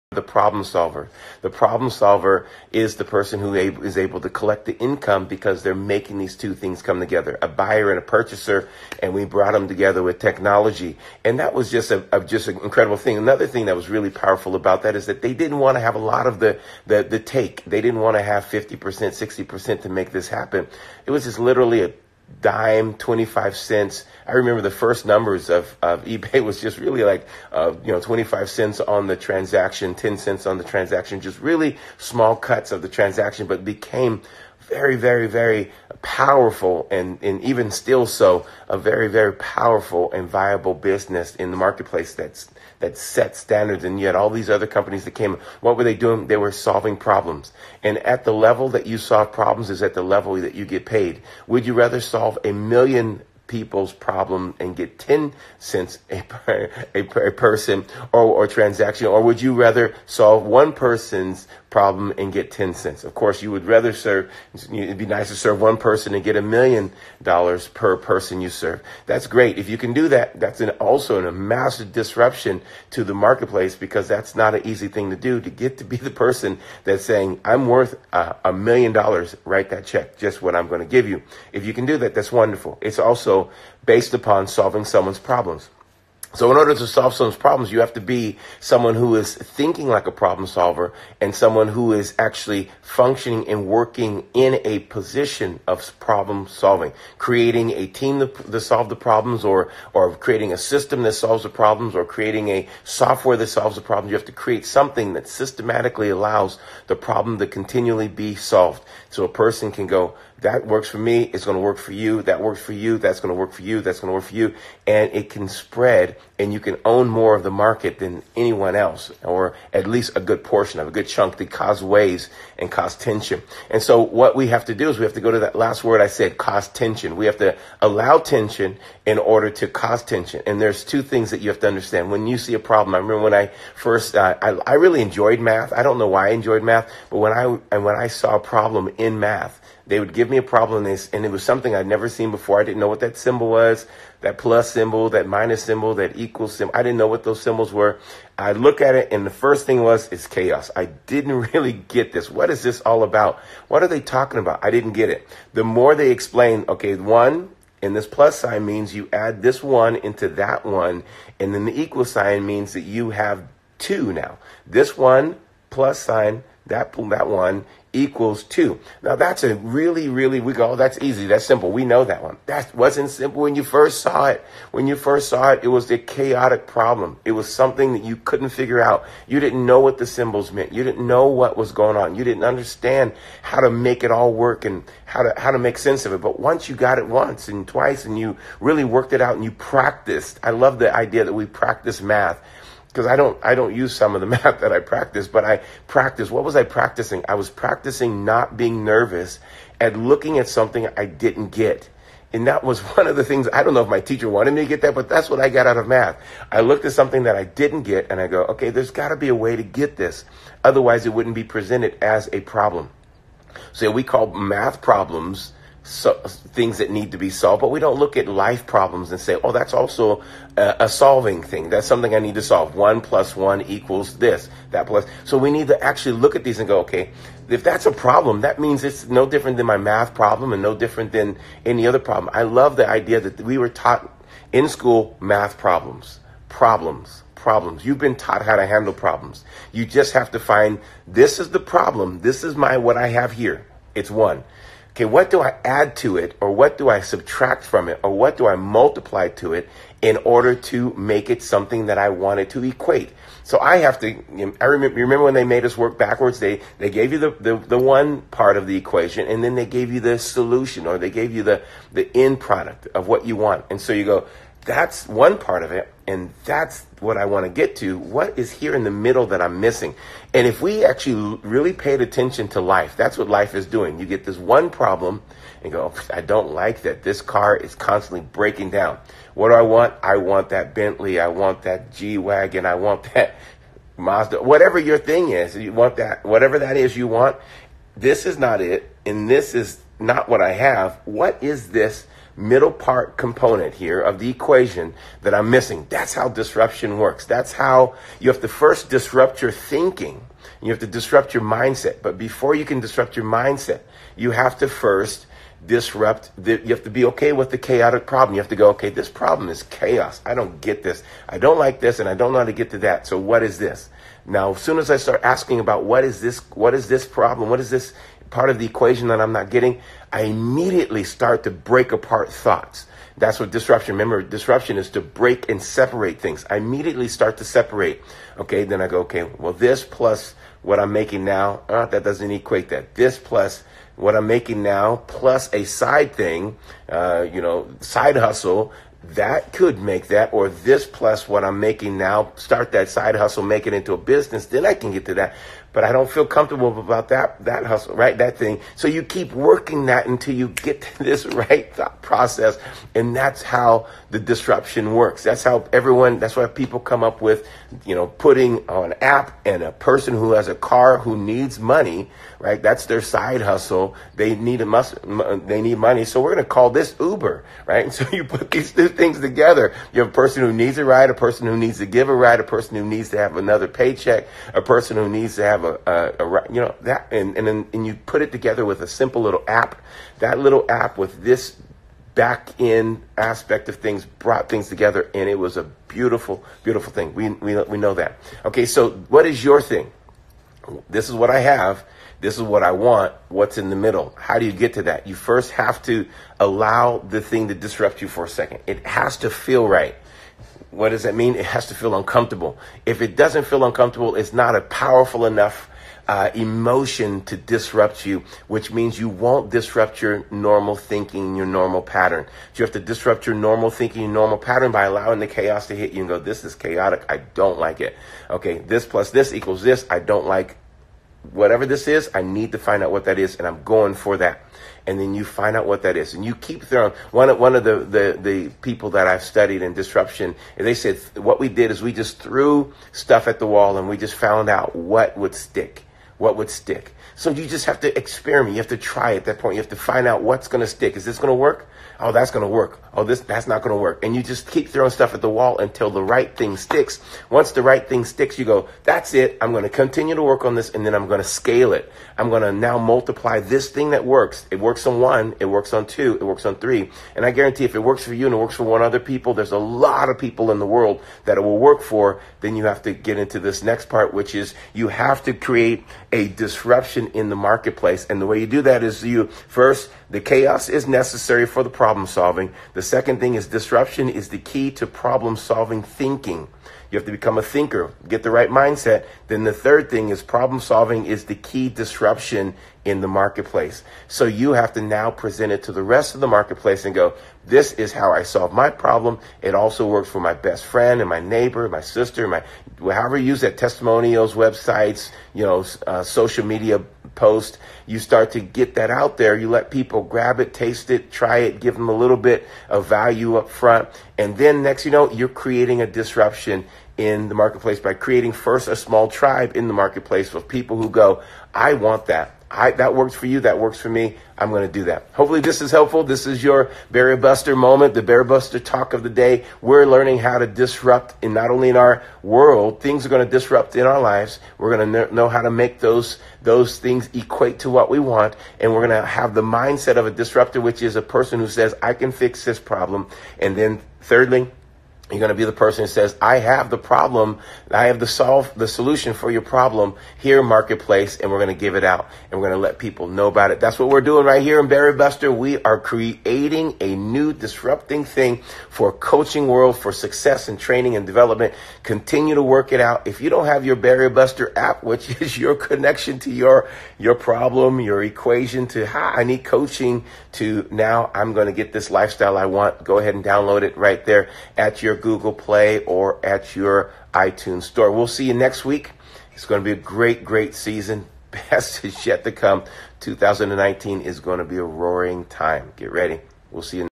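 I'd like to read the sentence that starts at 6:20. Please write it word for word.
That little app with this back end aspect of things brought things together, and it was a beautiful, beautiful thing.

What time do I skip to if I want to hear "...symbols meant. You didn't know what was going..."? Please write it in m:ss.
3:00.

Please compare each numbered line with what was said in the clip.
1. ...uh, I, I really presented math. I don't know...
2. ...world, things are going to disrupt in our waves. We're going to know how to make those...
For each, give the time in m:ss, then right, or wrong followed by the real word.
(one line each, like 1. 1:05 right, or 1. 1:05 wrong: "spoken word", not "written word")
1. 2:14 wrong: "enjoyed", not "presented"
2. 8:42 wrong: "lives", not "waves".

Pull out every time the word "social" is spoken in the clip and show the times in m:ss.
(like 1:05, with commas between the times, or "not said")
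8:16.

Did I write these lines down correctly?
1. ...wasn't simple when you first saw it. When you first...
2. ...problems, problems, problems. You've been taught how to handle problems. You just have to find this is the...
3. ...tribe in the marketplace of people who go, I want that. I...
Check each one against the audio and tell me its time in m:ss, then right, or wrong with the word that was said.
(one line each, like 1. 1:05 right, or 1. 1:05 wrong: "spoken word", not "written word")
1. 2:52 right
2. 3:55 right
3. 8:29 right.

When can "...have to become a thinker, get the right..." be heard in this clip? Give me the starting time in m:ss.
7:56.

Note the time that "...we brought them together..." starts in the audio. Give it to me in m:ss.
0:09.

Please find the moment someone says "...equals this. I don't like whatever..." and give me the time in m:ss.
6:59.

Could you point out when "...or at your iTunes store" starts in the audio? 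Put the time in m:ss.
9:25.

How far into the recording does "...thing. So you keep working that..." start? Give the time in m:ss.
5:48.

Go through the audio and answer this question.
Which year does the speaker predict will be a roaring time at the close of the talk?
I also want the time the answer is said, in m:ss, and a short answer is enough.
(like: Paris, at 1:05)
2019, at 9:33.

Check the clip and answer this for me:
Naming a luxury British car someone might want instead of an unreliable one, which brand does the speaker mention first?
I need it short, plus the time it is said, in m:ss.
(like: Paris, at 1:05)
Bentley, at 4:40.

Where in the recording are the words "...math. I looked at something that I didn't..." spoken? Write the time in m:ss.
3:25.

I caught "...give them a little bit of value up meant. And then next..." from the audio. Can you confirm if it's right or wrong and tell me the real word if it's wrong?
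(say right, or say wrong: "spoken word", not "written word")
wrong: "front", not "meant".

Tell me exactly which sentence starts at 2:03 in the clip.
And so what we have to do is we have to go to that last word I said, cause tension.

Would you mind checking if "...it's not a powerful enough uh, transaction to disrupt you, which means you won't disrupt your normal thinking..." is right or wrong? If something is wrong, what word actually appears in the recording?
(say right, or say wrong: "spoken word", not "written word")
wrong: "emotion", not "transaction".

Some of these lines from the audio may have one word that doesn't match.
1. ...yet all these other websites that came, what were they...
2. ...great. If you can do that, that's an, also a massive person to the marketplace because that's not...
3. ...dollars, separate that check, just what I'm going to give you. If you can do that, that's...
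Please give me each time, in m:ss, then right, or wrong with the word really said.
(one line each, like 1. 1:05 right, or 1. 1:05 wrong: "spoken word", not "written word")
1. 0:43 wrong: "companies", not "websites"
2. 1:09 wrong: "disruption", not "person"
3. 1:18 wrong: "write", not "separate".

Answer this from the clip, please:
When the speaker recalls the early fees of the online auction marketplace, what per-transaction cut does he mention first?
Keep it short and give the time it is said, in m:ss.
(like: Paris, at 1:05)
25 cents, at 0:27.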